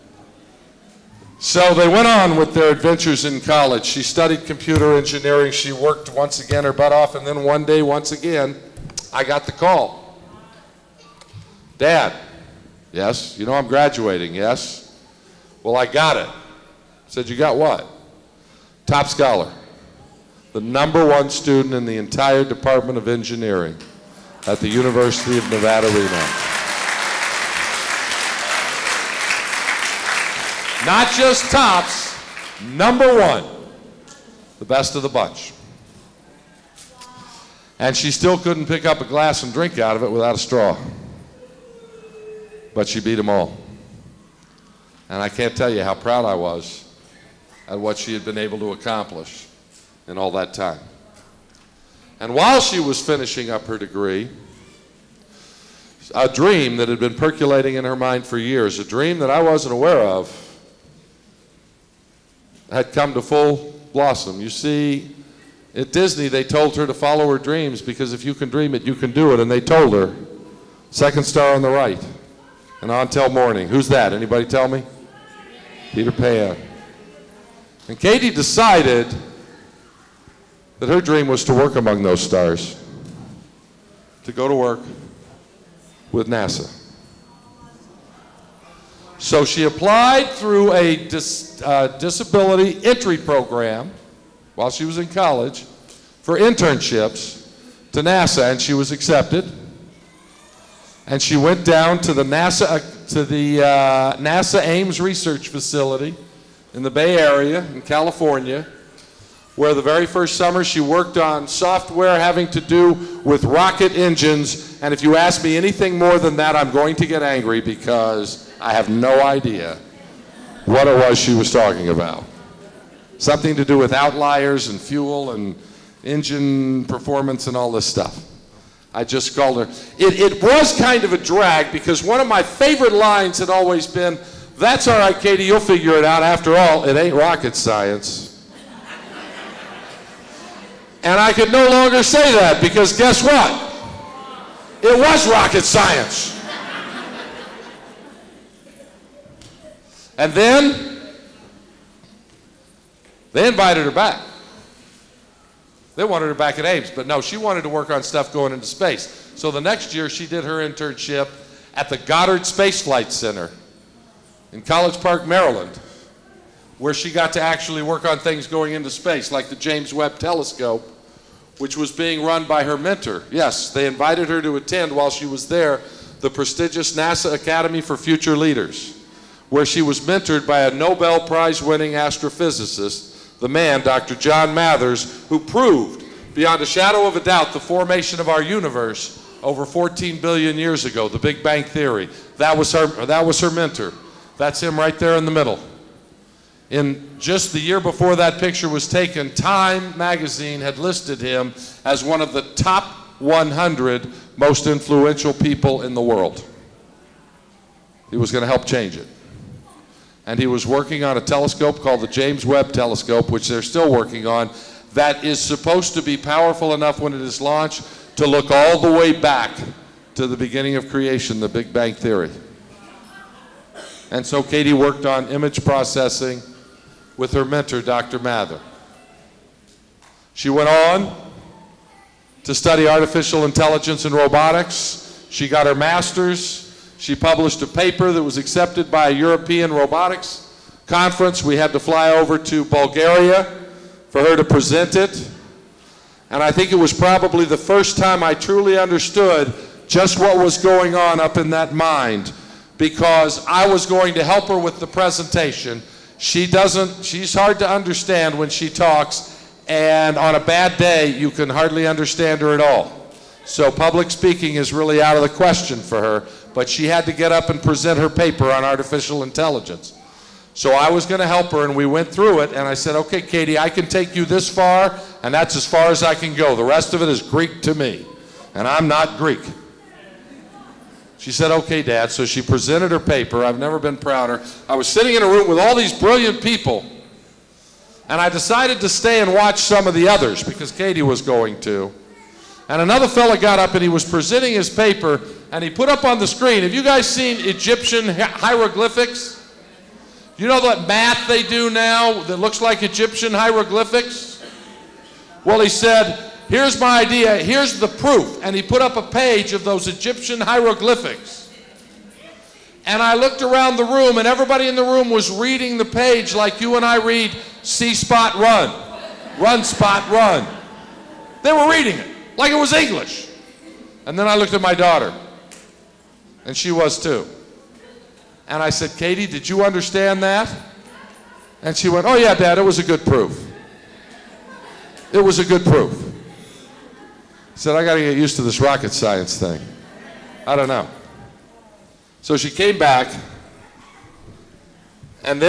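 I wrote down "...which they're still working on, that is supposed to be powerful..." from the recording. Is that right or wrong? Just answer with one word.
right.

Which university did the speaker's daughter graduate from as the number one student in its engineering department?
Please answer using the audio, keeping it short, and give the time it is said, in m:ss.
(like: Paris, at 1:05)
University of Nevada, Reno, at 0:24.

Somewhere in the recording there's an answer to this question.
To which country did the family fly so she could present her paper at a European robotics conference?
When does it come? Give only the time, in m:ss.
4:02.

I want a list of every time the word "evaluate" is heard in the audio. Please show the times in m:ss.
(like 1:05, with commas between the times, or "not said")
not said.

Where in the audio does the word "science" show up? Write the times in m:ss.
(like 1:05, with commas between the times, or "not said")
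2:17, 2:25, 5:38.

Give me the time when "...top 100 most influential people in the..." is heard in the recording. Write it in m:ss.
3:22.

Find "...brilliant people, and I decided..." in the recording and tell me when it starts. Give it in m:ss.
4:45.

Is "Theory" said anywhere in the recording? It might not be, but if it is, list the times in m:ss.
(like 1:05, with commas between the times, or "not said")
3:11, 3:41.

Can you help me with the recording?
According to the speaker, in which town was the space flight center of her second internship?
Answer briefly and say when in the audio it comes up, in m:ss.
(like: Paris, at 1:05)
College Park, Maryland, at 2:44.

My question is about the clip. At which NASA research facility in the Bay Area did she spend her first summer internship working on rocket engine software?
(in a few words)
Ames Research Facility.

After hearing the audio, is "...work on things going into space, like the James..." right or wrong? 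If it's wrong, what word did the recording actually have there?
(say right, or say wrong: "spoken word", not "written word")
right.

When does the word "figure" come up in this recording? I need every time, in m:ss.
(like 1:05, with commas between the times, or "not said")
2:15.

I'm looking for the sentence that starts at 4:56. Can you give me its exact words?
Have you guys seen Egyptian hieroglyphics?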